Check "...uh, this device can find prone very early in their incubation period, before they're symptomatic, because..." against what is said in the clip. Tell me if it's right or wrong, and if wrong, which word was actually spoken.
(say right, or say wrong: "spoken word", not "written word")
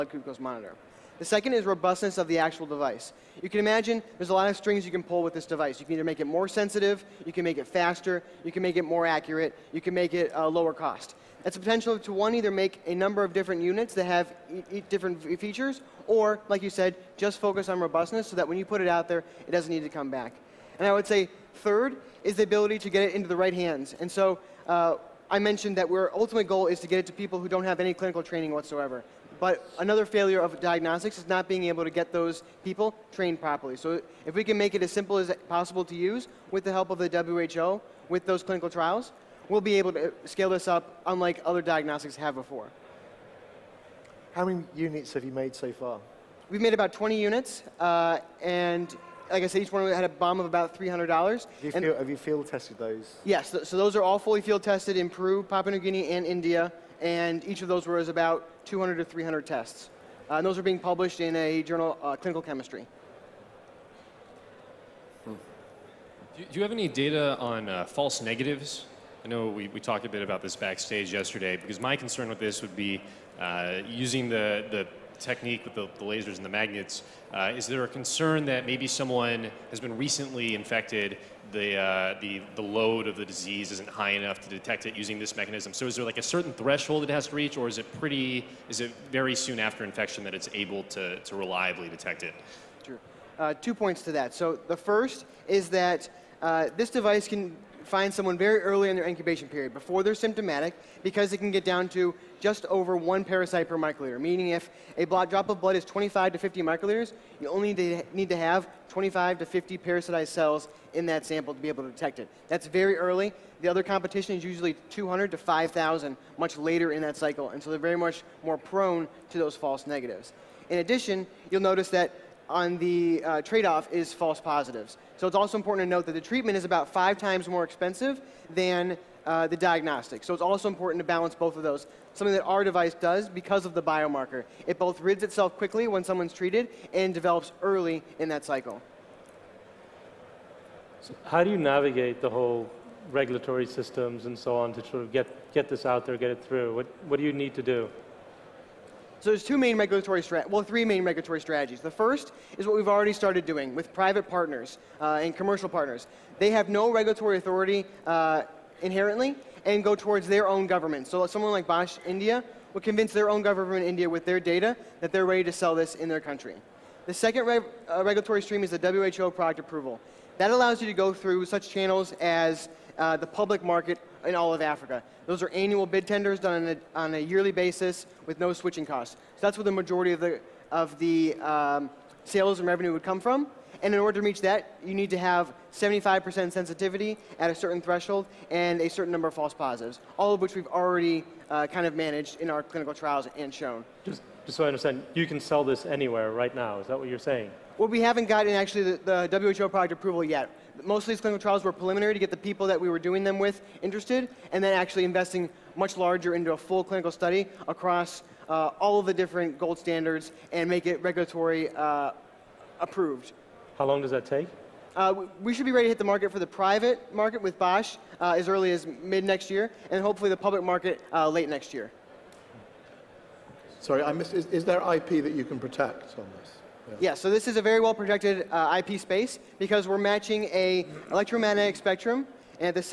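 wrong: "someone", not "prone".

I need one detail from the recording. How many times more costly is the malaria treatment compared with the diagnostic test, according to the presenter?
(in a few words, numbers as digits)
5.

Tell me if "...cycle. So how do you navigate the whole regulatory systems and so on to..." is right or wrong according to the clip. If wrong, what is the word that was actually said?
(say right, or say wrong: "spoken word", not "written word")
right.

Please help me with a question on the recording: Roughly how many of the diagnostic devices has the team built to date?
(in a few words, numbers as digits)
20.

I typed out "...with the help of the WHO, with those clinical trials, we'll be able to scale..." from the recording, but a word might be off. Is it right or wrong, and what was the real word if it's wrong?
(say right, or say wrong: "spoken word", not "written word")
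right.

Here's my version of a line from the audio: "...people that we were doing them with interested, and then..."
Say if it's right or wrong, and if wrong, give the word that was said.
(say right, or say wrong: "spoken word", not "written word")
right.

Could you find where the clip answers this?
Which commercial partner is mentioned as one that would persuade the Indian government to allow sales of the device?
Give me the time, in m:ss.
2:41.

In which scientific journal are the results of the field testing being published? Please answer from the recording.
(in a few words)
Clinical Chemistry.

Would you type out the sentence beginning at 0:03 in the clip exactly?
You can imagine there's a lot of strings you can pull with this device.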